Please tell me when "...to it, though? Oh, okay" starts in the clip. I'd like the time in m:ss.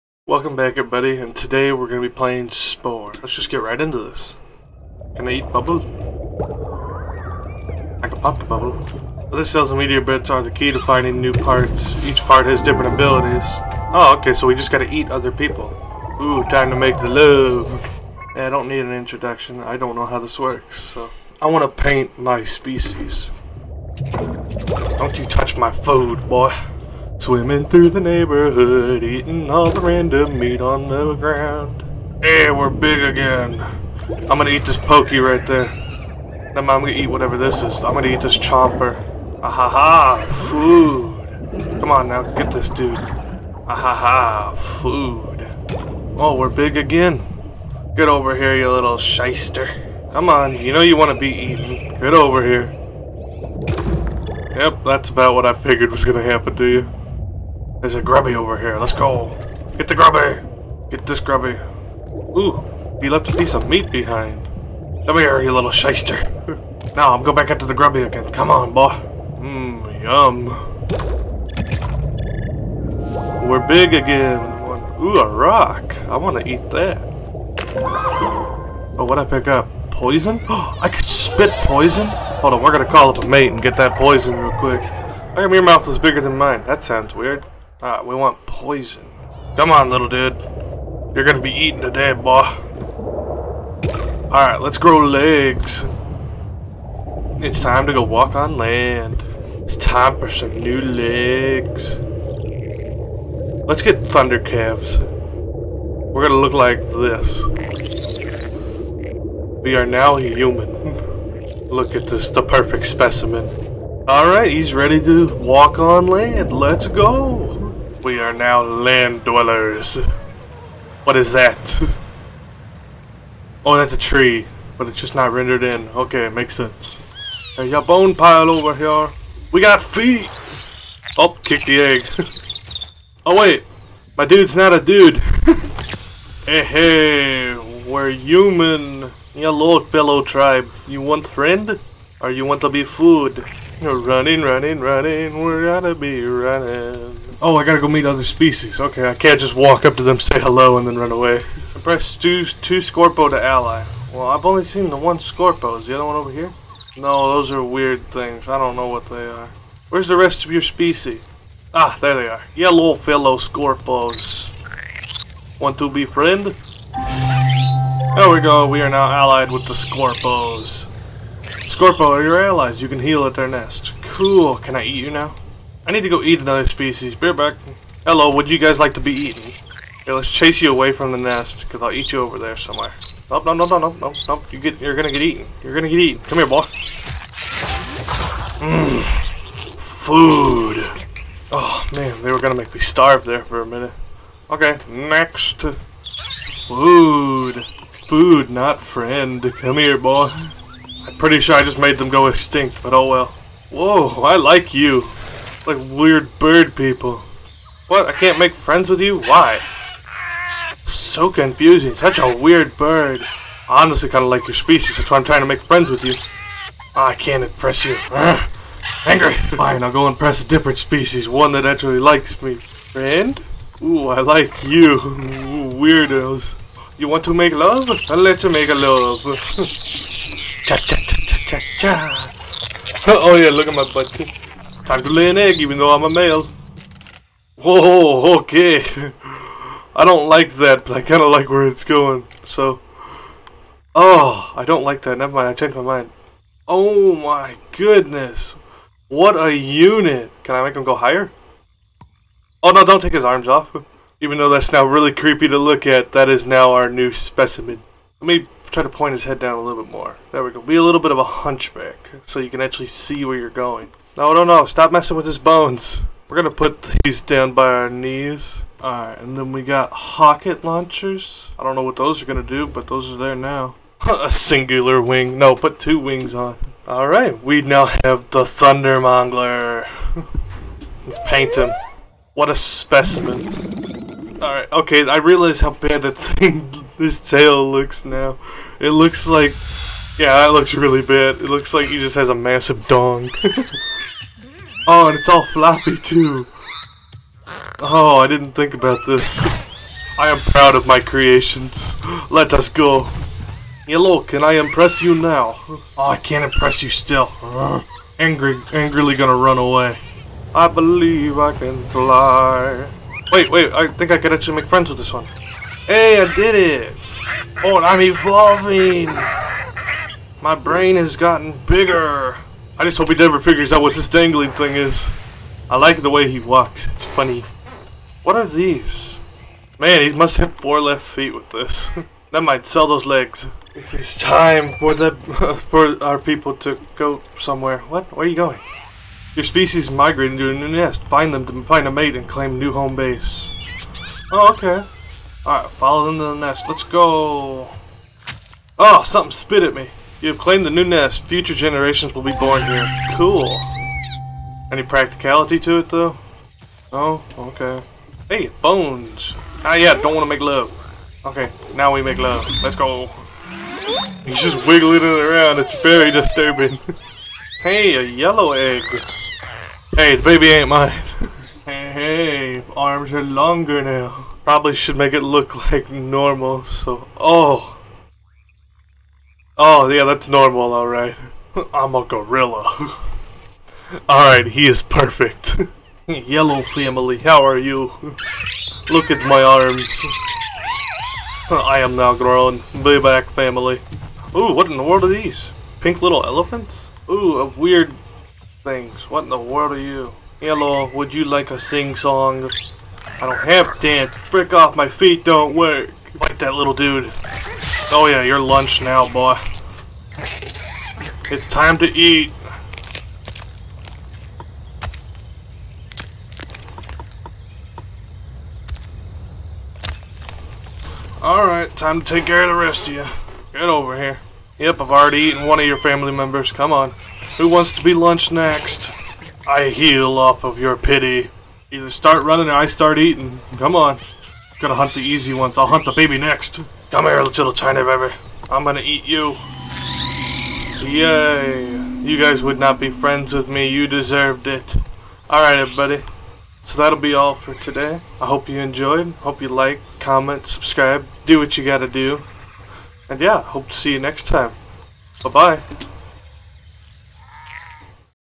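5:55.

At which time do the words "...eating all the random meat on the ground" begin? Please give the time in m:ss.
0:29.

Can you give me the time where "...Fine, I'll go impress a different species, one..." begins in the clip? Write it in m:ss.
3:39.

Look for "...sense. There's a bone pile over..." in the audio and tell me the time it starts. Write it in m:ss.
2:06.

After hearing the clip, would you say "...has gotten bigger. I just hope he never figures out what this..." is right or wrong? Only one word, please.
right.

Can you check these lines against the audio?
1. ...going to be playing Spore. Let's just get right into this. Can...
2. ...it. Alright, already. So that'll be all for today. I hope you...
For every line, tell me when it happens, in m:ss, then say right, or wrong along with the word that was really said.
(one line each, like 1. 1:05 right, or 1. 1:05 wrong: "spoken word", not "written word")
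1. 0:01 right
2. 7:24 wrong: "everybody", not "already".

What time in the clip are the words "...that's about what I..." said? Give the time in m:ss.
0:54.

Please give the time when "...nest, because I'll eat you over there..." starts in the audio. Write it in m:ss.
3:01.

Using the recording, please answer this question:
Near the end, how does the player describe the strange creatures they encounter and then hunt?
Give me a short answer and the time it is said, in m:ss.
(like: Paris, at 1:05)
Pink little elephants, at 6:35.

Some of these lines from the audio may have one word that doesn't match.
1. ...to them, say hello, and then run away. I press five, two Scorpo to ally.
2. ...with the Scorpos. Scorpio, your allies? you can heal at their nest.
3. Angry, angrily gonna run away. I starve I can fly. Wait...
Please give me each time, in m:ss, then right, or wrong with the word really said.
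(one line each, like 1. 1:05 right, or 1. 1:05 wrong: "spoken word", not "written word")
1. 2:29 wrong: "two", not "five"
2. 2:49 right
3. 5:08 wrong: "believe", not "starve".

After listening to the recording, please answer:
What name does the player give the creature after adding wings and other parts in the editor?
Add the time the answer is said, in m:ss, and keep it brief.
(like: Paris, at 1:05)
Thundermongler, at 4:38.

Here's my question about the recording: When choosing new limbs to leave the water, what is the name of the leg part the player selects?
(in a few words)
Thunder calves.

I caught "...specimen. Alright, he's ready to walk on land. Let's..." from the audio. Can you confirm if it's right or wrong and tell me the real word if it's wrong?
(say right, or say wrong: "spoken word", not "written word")
right.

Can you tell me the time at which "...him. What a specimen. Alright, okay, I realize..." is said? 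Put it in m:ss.
4:41.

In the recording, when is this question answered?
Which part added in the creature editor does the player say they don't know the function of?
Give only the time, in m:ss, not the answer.
4:29.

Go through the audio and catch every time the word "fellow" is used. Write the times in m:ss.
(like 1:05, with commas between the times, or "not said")
2:19, 2:42.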